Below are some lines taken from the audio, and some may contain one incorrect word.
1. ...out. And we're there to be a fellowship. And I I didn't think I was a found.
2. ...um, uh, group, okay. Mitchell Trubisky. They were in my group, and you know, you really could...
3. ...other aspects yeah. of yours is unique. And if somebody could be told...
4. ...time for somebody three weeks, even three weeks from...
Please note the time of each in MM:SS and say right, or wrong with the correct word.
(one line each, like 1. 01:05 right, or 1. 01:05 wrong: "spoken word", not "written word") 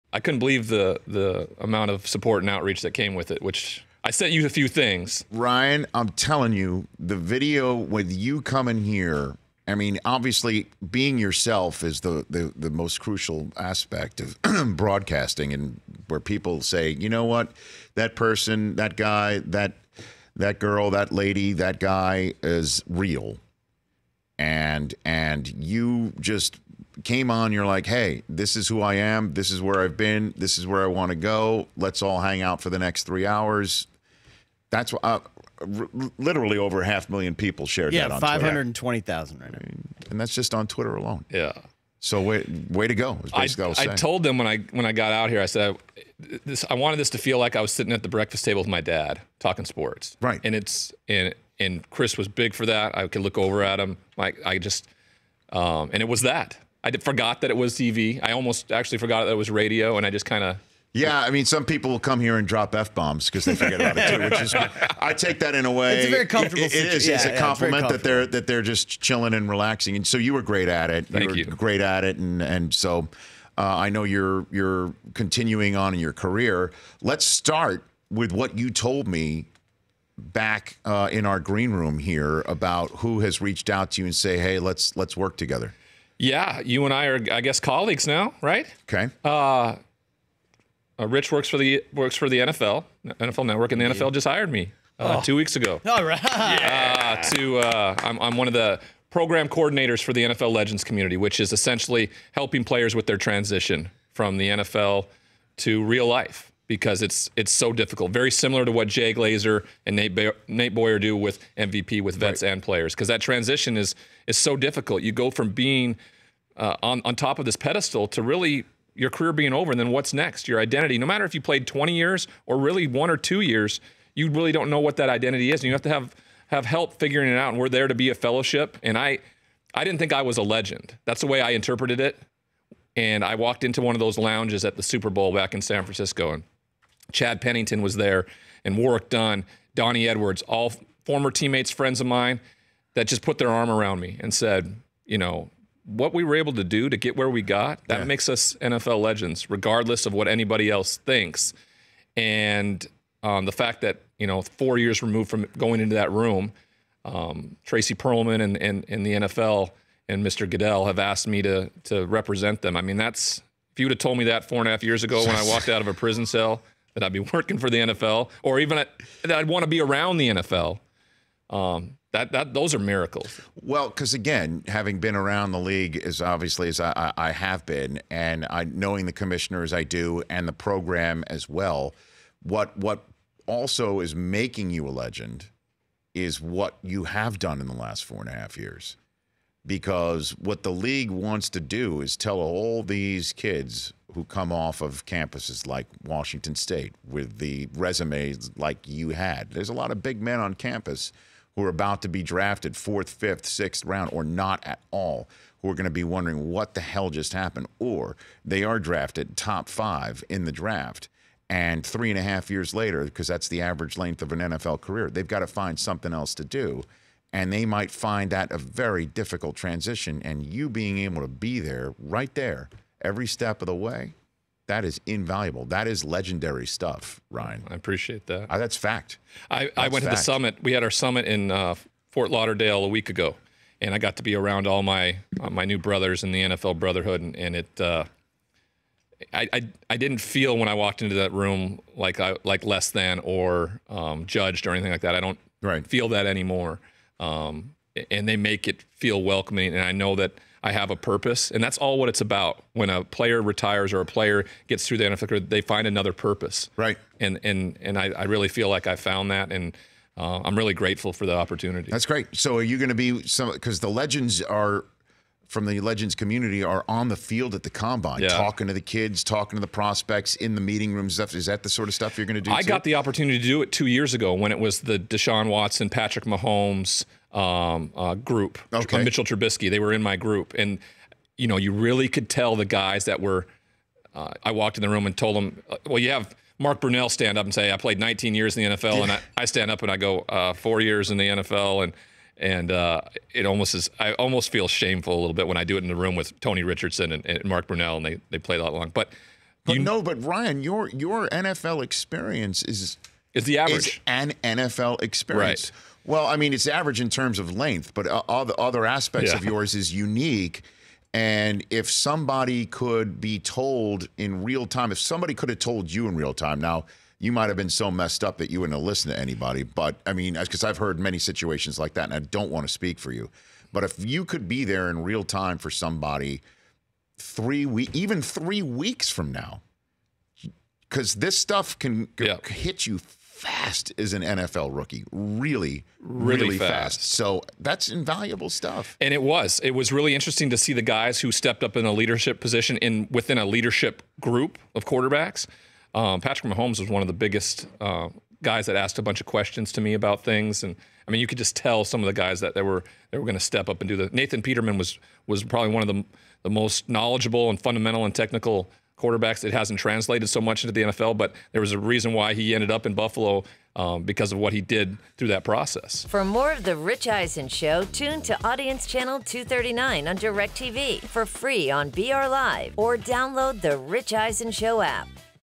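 1. 02:07 wrong: "legend", not "found"
2. 04:37 right
3. 05:08 right
4. 05:25 right.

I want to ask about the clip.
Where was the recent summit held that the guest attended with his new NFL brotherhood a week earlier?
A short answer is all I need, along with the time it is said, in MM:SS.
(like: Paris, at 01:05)
Fort Lauderdale, at 03:52.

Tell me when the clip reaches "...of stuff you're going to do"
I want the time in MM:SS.
04:31.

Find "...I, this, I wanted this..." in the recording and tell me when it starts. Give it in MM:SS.
00:46.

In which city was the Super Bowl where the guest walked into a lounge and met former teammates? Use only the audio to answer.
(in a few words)
San Francisco.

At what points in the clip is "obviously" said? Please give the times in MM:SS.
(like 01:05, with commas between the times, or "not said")
00:10, 02:56.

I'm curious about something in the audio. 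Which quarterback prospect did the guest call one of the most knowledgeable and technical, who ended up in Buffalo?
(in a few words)
Nathan Peterman.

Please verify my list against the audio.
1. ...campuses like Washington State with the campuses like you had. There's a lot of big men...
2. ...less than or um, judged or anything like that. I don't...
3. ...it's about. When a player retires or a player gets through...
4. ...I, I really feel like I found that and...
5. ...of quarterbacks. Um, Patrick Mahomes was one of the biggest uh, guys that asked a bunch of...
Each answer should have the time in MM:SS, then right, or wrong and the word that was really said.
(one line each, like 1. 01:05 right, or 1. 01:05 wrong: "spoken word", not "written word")
1. 03:15 wrong: "resumes", not "campuses"
2. 04:02 right
3. 04:12 right
4. 04:17 right
5. 05:44 right.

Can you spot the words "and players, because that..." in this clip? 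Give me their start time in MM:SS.
01:52.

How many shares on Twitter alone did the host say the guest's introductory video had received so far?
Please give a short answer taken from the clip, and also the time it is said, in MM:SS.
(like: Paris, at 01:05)
520,000, at 00:38.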